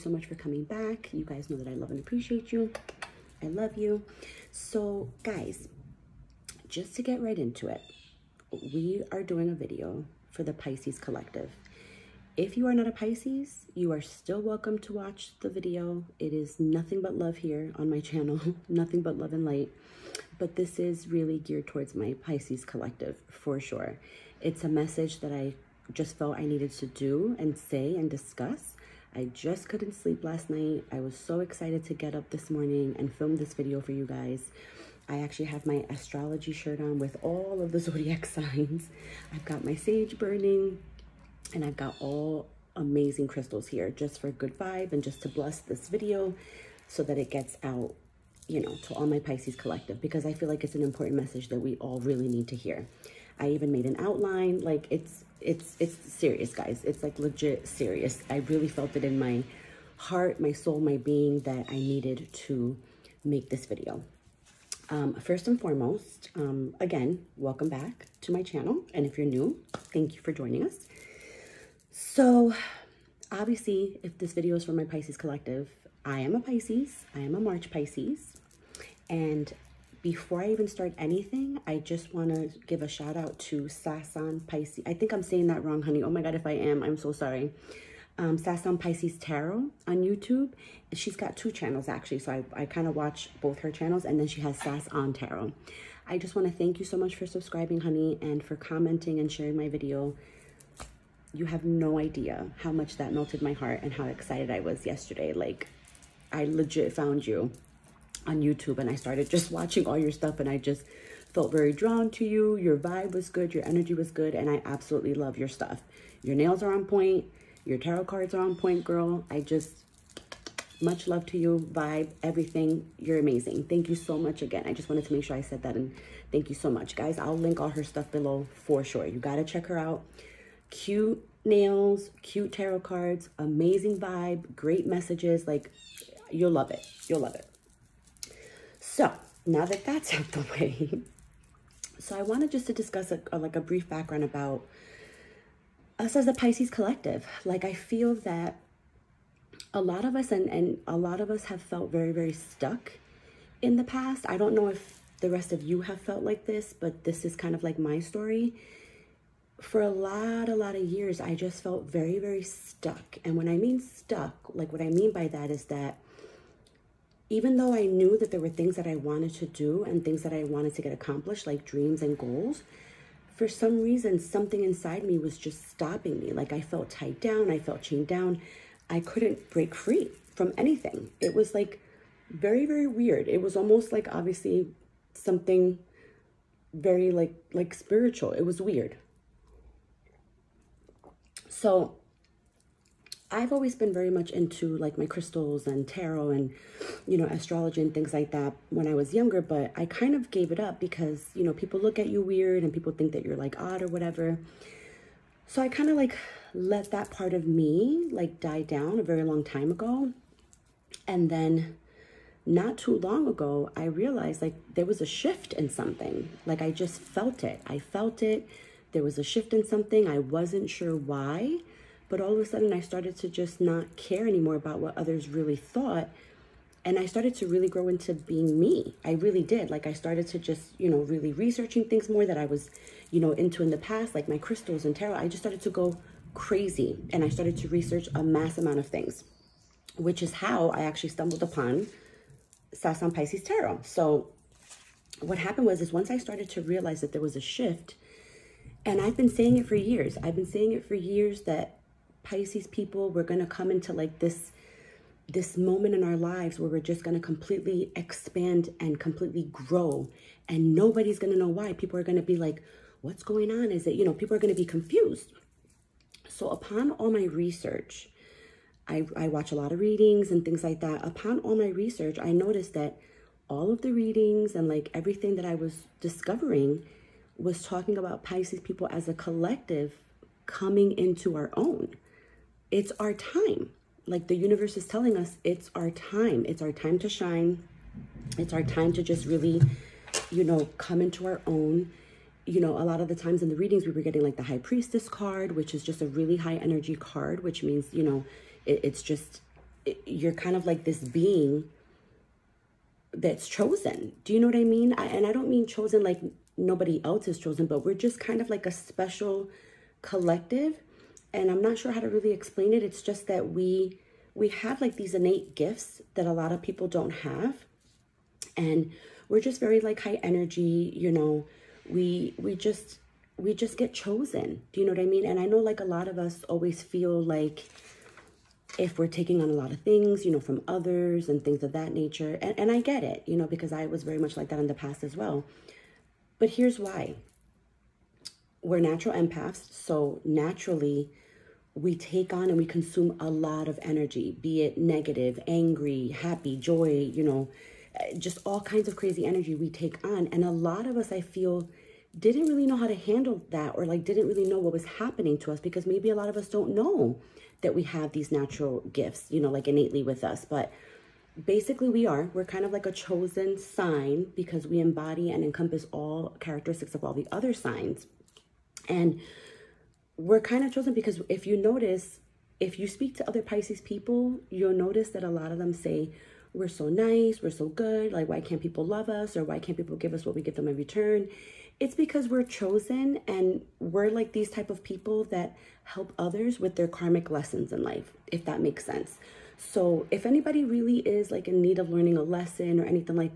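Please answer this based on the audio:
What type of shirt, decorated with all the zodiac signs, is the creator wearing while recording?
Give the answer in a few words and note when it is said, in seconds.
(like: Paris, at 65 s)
Astrology shirt, at 35 s.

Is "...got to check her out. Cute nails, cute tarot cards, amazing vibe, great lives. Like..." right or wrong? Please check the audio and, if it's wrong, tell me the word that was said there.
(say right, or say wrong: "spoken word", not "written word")
wrong: "messages", not "lives".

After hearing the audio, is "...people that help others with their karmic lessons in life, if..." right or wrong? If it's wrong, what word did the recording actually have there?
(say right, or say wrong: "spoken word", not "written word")
right.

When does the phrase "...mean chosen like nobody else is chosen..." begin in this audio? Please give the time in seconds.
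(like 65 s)
305 s.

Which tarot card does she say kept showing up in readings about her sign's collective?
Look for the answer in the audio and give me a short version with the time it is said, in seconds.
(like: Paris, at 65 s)
The High Priestess, at 294 s.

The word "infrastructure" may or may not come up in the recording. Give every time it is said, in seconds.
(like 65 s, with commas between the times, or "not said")
not said.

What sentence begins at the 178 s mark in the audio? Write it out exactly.
I couldn't break free from anything.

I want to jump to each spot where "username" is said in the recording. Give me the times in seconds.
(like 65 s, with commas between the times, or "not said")
not said.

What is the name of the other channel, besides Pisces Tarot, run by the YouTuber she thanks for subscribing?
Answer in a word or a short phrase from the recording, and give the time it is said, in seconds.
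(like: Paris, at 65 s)
Sass on Tarot, at 94 s.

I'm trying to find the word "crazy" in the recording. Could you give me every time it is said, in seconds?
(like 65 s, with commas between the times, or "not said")
236 s, 348 s.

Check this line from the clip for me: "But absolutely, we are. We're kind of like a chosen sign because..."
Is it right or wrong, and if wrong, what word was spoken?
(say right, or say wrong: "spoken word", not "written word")
wrong: "basically", not "absolutely".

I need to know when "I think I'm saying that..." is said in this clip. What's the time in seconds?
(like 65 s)
84 s.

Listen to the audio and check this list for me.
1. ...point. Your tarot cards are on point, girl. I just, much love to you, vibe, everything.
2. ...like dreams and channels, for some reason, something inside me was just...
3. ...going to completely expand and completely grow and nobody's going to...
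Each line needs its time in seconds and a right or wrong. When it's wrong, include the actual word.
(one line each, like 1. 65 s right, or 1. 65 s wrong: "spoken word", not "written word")
1. 116 s right
2. 171 s wrong: "goals", not "channels"
3. 257 s right.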